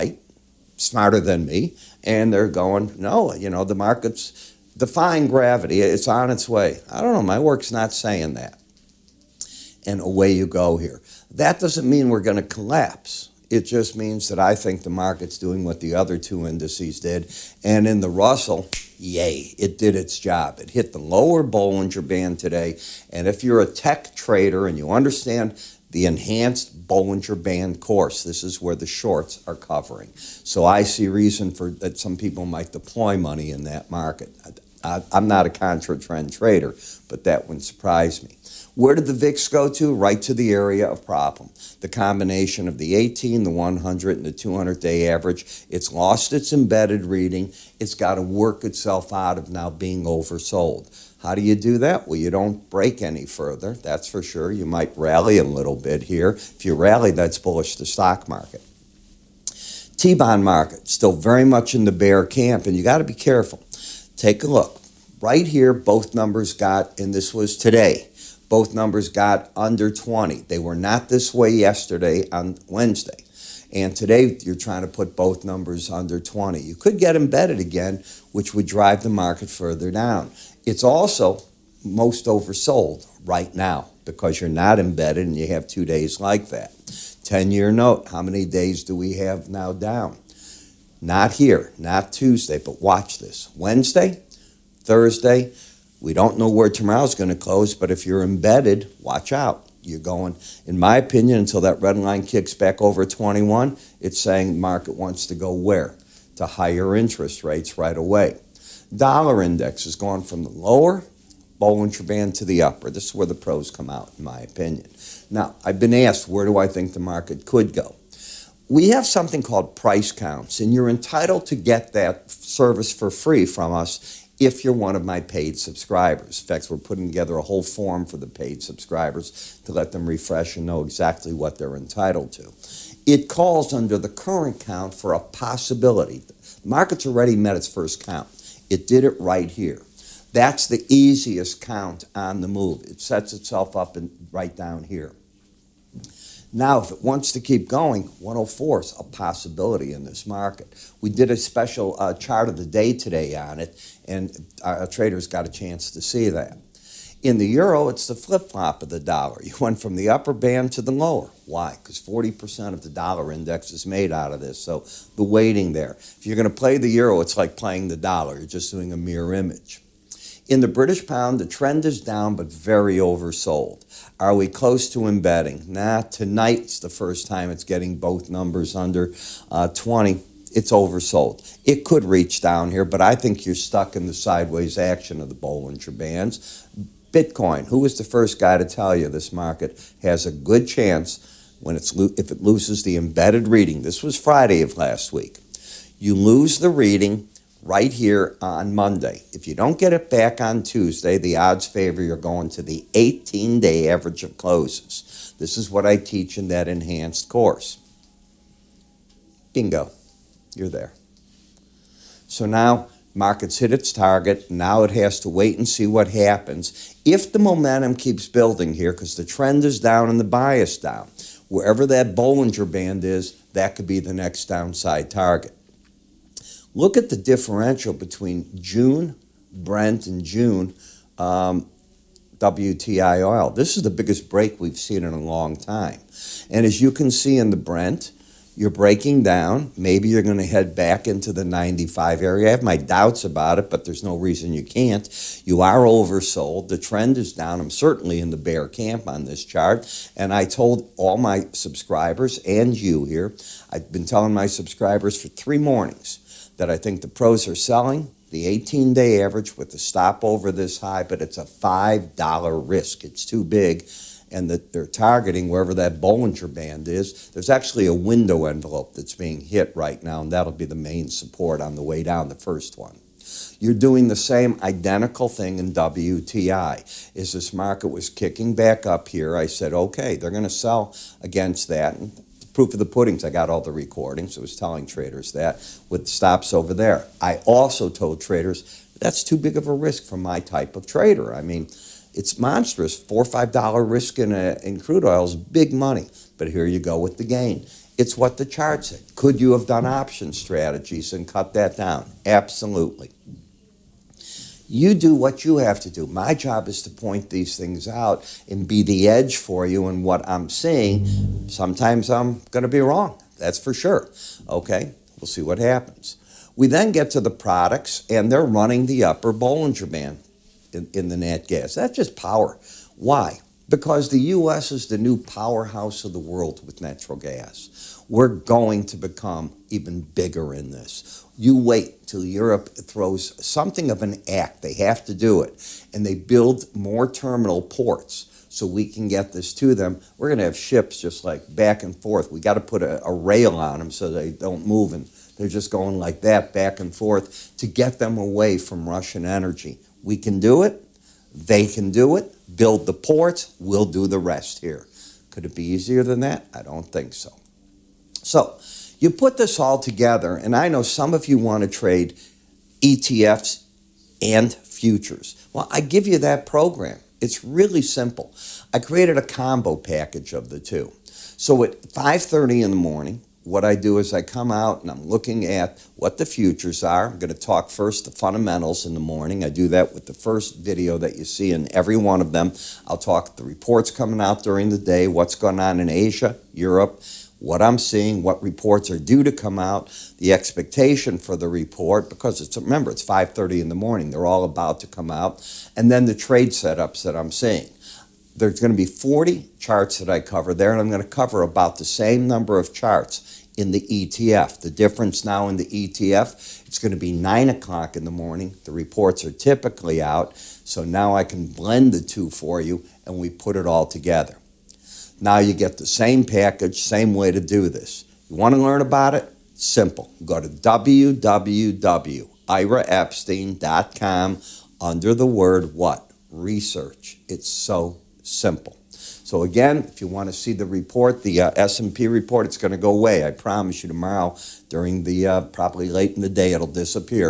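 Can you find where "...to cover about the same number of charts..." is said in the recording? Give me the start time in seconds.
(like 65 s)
401 s.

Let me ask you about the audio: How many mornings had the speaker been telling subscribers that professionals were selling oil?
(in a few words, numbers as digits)
3.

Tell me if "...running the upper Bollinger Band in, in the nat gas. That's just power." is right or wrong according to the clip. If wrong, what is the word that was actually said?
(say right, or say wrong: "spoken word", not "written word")
right.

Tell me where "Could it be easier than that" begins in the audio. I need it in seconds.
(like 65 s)
355 s.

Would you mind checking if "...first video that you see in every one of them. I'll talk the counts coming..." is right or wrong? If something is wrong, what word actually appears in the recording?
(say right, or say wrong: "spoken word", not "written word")
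wrong: "reports", not "counts".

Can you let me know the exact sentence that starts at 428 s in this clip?
So again, if you want to see the report, the uh, S&P report, it's going to go away.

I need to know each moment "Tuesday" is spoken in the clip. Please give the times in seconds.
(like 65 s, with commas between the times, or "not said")
92 s, 200 s.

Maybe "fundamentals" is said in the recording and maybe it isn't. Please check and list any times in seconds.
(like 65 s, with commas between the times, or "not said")
378 s.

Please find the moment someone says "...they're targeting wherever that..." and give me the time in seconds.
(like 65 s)
264 s.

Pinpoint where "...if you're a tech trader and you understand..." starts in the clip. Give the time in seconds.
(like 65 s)
23 s.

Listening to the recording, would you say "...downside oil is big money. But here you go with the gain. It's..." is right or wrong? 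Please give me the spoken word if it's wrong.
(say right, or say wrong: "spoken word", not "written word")
wrong: "crude", not "downside".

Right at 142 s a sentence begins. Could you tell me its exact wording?
It sets itself up right down here.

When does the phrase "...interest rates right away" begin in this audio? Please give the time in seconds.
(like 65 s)
106 s.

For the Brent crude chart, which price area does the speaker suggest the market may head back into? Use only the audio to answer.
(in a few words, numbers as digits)
95.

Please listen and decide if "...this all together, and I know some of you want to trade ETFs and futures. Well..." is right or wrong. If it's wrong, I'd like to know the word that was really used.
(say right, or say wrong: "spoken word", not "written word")
right.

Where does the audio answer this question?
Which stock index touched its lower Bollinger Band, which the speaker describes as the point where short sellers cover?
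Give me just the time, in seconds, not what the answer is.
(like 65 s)
18 s.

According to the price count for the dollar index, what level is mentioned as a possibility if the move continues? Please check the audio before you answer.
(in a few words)
104.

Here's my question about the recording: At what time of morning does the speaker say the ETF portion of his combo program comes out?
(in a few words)
9 o'clock.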